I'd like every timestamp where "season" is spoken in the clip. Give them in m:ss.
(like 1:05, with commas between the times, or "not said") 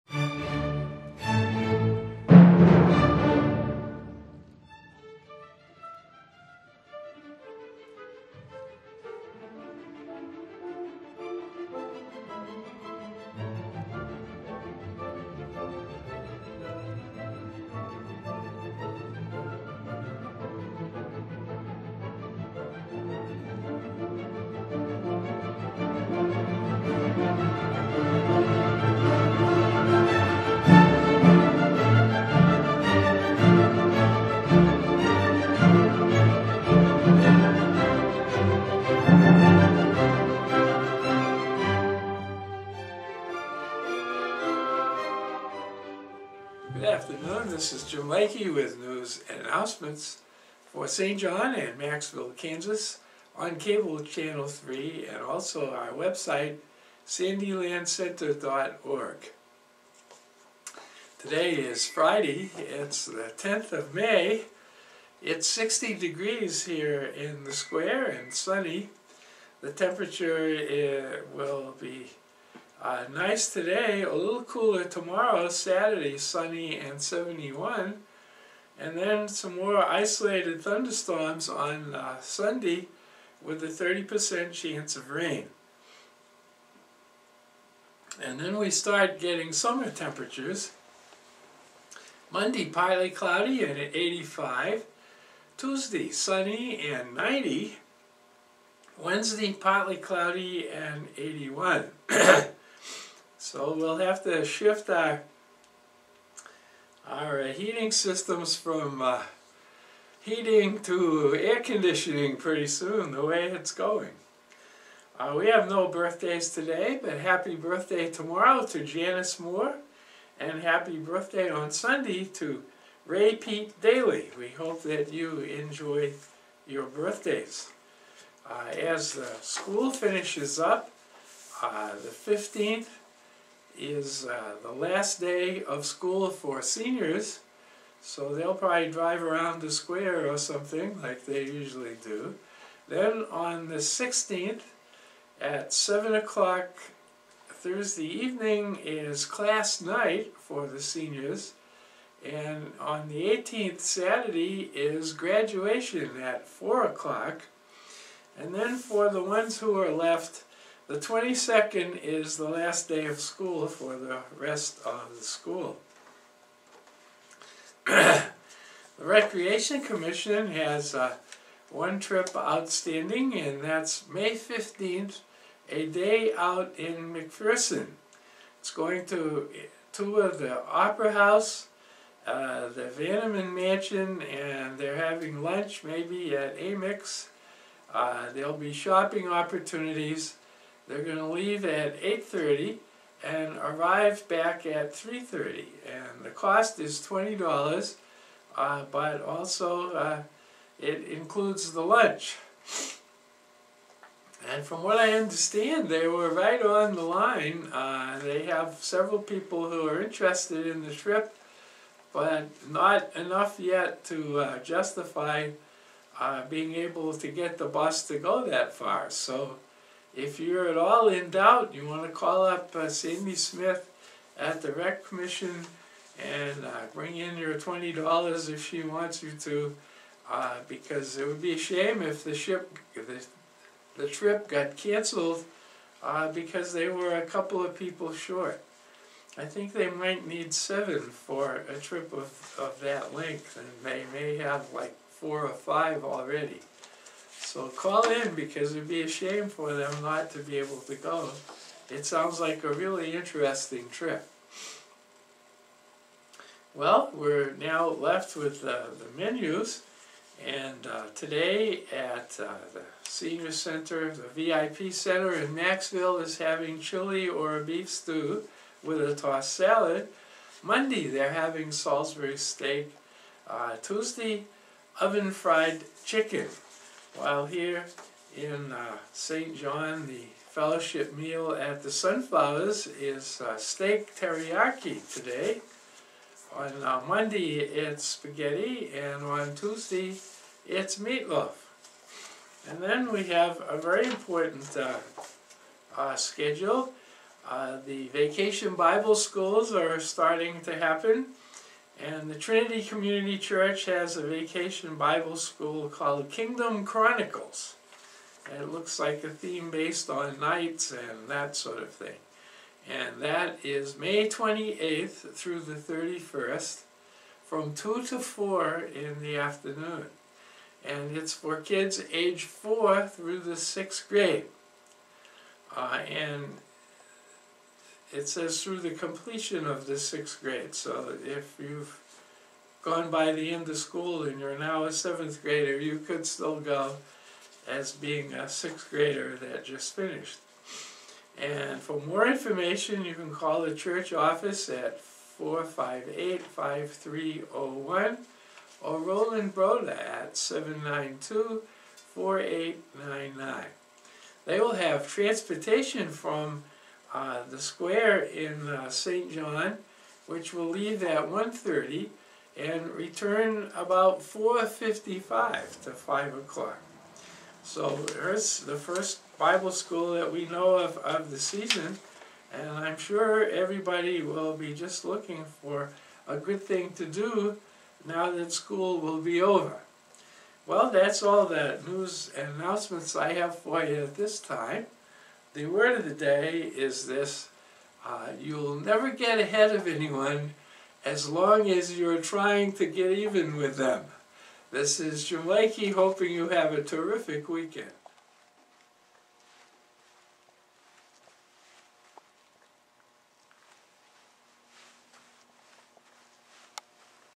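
6:11.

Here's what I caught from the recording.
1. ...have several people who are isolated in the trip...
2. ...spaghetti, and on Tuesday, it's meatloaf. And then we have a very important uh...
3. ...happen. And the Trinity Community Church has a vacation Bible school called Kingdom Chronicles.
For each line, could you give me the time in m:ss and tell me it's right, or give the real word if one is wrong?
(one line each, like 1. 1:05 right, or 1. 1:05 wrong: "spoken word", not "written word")
1. 3:28 wrong: "interested", not "isolated"
2. 4:48 right
3. 5:00 right.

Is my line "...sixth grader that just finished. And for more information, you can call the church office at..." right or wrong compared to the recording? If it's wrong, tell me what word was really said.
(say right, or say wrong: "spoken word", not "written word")
right.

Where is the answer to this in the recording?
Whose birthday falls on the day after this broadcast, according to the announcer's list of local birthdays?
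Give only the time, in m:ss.
1:58.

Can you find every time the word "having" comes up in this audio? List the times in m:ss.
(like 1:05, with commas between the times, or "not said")
3:04, 4:26, 4:31.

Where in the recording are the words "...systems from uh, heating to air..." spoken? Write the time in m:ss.
1:47.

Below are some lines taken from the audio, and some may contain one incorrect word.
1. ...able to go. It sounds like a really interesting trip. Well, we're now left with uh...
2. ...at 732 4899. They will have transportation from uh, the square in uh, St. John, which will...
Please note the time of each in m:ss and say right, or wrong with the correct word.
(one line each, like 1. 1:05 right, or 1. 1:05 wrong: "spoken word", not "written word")
1. 4:10 right
2. 5:49 wrong: "792", not "732".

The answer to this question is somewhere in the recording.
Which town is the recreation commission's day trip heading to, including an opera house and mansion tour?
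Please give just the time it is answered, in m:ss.
2:57.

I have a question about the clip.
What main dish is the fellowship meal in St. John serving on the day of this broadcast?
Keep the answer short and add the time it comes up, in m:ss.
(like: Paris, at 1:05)
Steak teriyaki, at 4:43.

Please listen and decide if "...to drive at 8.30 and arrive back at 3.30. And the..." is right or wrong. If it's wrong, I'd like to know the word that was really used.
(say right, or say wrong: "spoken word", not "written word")
wrong: "leave", not "drive".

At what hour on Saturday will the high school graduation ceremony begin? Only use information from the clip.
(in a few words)
4 o'clock.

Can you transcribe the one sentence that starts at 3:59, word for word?
I think they might need seven for a trip of, of that length, and they may have like four or five already.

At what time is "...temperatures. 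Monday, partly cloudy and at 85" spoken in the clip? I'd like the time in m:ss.
1:29.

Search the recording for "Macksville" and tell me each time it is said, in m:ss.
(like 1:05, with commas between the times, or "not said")
0:51, 4:25.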